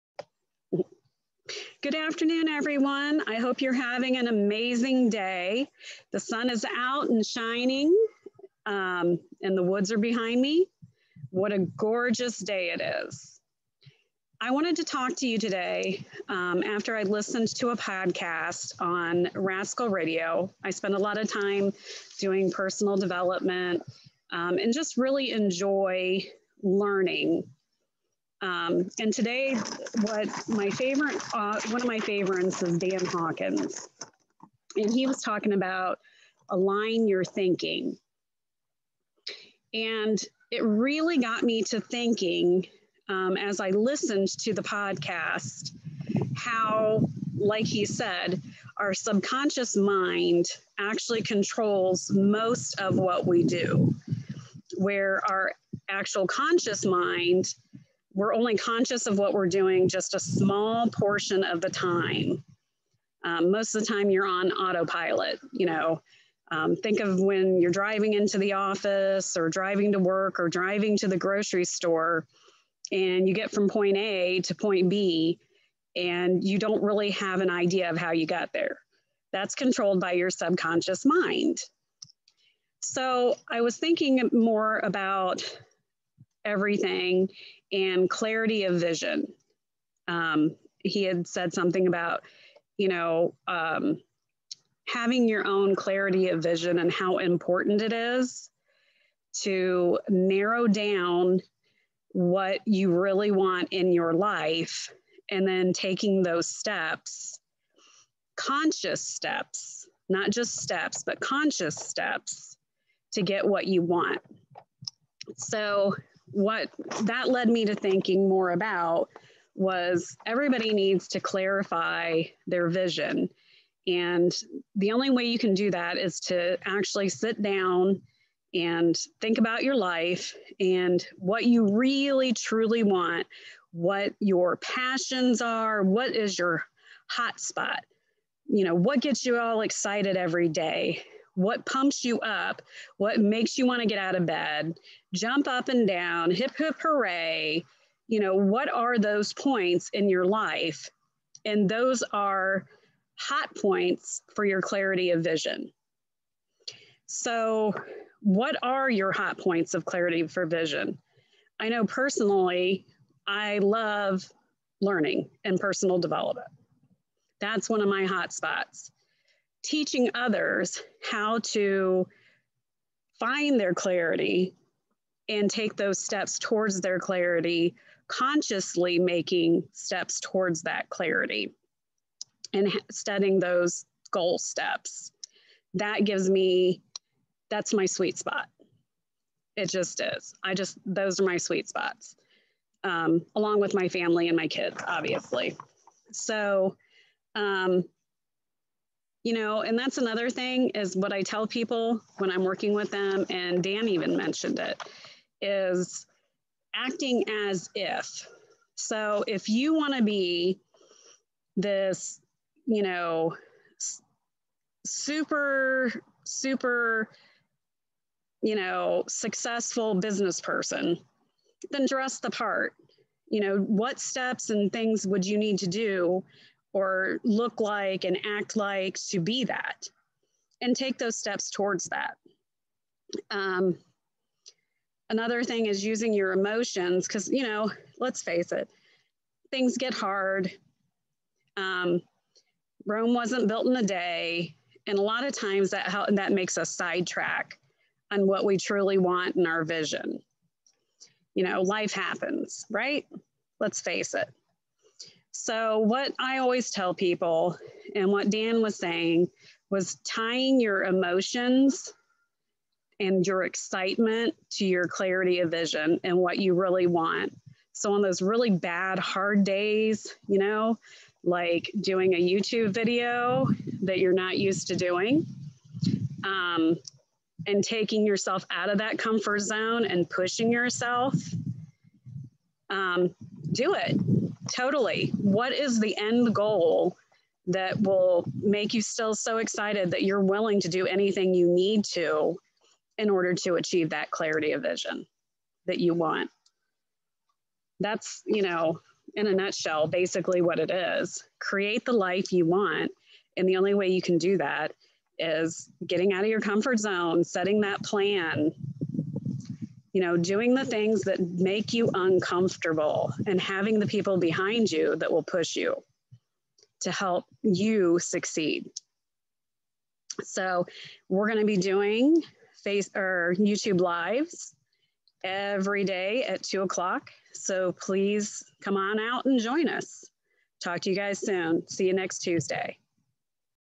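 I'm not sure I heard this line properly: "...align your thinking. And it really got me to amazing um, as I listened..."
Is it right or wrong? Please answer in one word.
wrong.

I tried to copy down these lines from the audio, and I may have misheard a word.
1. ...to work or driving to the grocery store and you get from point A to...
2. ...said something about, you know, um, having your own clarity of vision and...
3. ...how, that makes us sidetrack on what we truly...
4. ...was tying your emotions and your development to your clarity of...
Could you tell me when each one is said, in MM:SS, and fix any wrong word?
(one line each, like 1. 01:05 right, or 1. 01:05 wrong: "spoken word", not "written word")
1. 01:09 right
2. 01:31 right
3. 04:05 right
4. 04:19 wrong: "excitement", not "development".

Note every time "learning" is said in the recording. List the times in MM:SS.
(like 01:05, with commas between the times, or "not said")
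00:26, 02:44.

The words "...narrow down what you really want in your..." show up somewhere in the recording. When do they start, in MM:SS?
01:40.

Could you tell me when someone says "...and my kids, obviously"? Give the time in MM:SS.
03:14.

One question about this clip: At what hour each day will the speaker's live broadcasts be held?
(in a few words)
2 o'clock.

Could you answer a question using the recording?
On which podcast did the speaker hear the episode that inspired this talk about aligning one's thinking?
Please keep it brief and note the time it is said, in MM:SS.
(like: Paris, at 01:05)
Rascal Radio, at 00:19.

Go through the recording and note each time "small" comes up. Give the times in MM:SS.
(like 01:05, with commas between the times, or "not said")
01:00.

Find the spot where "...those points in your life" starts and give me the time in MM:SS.
02:28.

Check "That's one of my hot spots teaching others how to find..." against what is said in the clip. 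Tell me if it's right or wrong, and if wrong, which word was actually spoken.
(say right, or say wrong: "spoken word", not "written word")
right.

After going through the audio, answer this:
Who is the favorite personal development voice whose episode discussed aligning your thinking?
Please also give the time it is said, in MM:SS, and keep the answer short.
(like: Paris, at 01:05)
Dan Hawkins, at 00:32.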